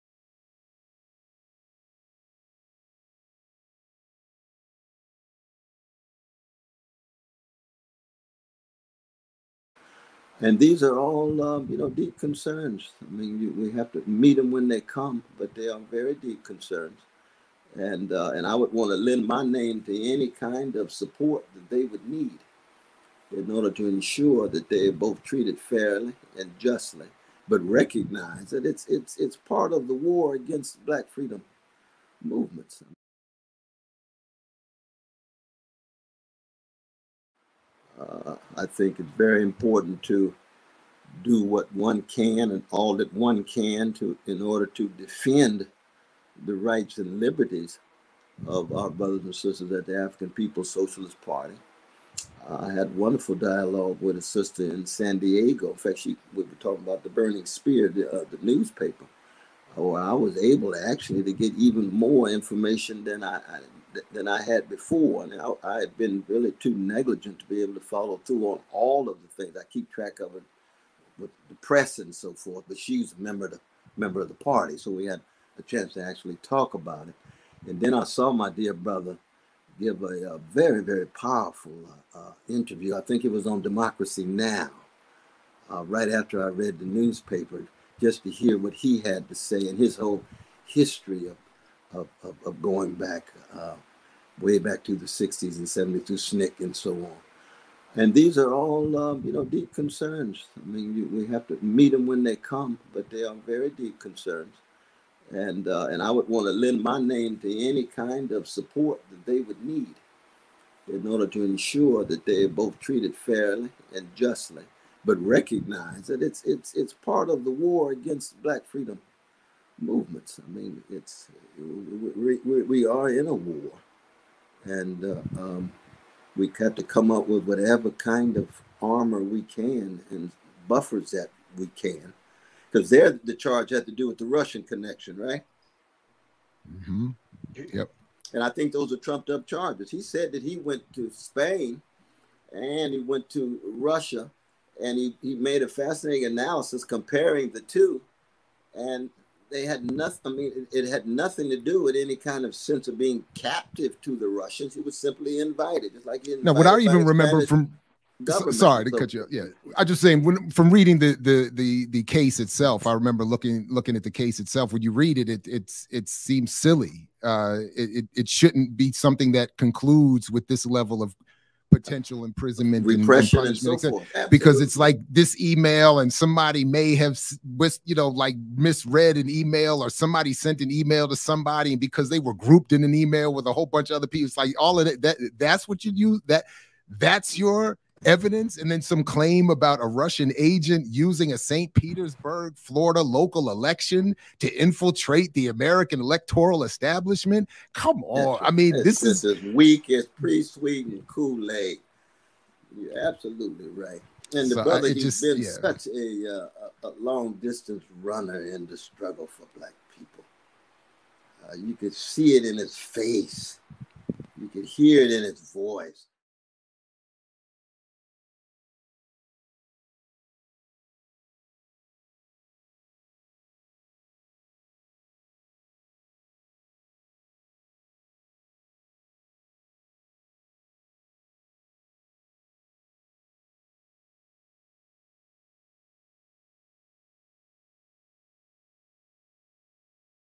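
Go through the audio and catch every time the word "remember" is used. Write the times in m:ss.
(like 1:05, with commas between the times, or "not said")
2:37, 2:42.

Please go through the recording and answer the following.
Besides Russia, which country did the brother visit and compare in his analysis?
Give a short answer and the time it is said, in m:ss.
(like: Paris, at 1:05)
Spain, at 2:21.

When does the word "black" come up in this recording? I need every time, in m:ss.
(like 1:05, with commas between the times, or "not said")
0:30, 1:58, 3:29.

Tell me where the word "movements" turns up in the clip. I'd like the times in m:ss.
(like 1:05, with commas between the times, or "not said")
0:32, 1:59.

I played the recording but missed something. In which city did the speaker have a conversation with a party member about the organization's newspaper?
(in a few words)
San Diego.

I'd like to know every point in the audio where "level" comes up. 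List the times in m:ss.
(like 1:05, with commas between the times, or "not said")
2:50.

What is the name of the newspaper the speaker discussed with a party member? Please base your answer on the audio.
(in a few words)
The Burning Spear.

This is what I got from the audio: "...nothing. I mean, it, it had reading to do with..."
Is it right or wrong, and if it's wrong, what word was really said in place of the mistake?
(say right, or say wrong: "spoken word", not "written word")
wrong: "nothing", not "reading".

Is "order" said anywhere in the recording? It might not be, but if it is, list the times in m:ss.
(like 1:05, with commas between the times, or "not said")
0:23, 0:44, 1:51.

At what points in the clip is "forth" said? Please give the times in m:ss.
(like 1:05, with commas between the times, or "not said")
1:12, 2:53.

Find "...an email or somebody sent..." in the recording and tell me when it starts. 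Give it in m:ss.
2:59.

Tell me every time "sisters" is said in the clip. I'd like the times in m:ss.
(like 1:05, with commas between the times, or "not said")
0:49, 0:54.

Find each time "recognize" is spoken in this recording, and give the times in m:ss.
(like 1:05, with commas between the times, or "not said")
0:27, 1:55.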